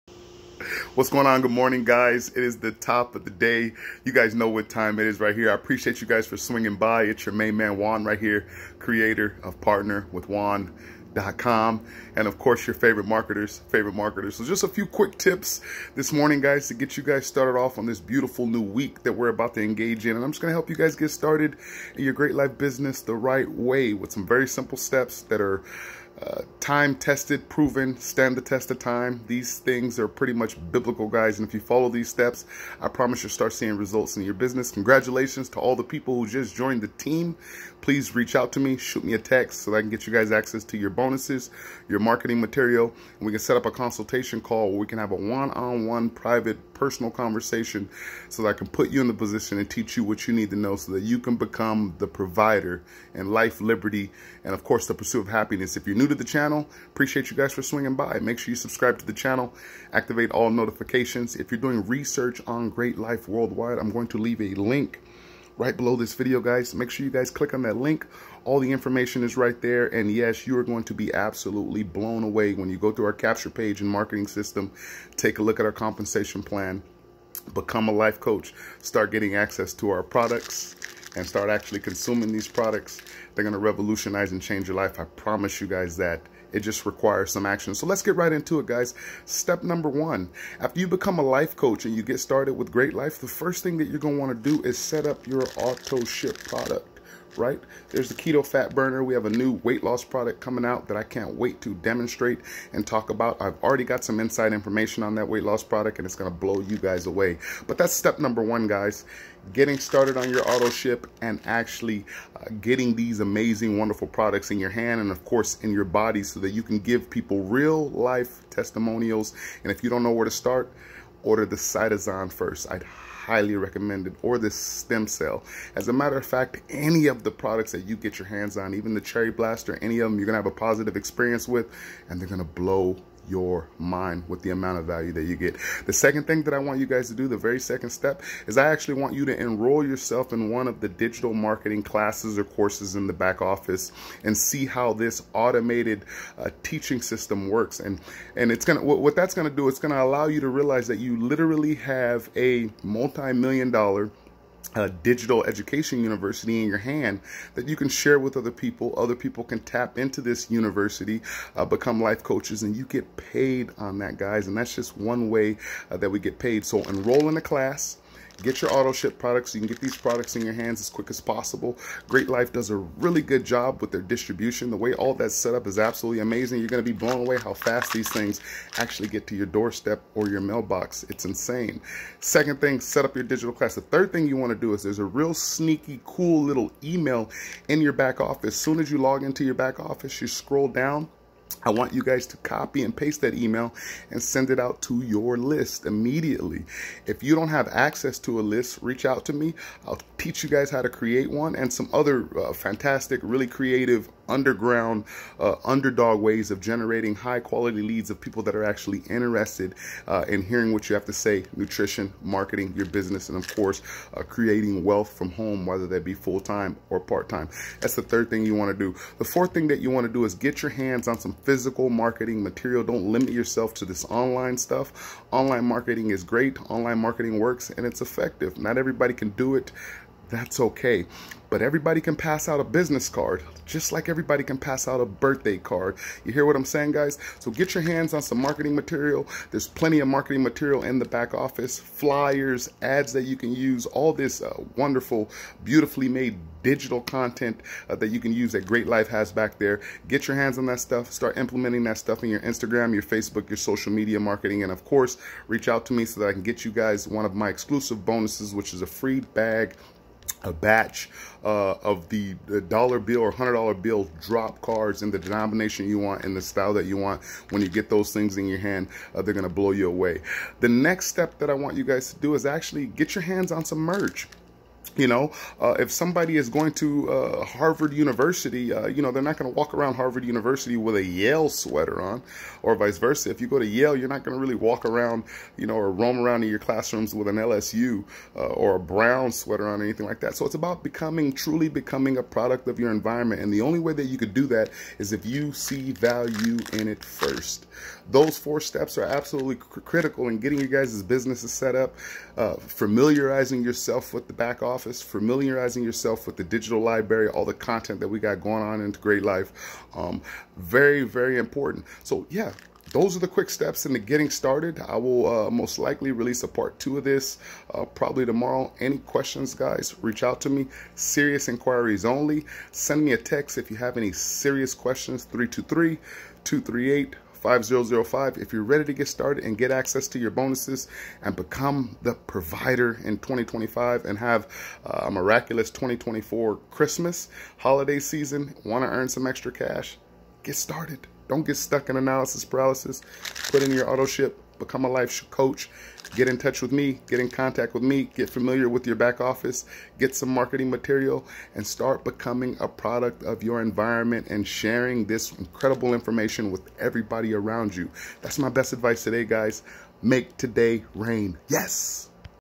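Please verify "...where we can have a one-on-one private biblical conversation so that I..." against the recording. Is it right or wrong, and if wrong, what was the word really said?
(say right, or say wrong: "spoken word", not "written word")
wrong: "personal", not "biblical".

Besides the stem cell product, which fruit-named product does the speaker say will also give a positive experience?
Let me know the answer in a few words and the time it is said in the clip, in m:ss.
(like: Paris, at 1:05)
Cherry Blaster, at 2:09.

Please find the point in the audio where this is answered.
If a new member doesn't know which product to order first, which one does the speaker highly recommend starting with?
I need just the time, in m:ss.
2:01.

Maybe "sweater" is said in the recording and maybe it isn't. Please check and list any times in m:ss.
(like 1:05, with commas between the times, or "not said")
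4:41, 4:49.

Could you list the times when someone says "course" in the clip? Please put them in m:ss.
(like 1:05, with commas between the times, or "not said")
0:12, 0:54, 1:55, 2:22, 3:33, 4:14.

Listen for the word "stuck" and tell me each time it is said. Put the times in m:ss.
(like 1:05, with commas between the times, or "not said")
5:41.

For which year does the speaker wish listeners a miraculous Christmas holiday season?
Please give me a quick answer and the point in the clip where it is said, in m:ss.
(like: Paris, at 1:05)
2024, at 5:35.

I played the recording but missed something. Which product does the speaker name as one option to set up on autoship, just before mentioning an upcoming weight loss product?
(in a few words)
Keto Fat Burner.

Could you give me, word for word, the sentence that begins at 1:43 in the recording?
I've already got some inside information on that weight loss product and it's gonna blow you guys away.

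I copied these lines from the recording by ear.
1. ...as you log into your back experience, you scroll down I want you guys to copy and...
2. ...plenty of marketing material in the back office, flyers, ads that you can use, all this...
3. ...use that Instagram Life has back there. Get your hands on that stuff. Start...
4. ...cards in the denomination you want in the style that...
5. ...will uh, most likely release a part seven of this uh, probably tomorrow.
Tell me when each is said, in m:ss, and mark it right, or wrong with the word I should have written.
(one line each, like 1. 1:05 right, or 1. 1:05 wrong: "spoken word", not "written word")
1. 3:08 wrong: "office", not "experience"
2. 3:59 right
3. 4:08 wrong: "Great", not "Instagram"
4. 4:24 right
5. 5:14 wrong: "two", not "seven".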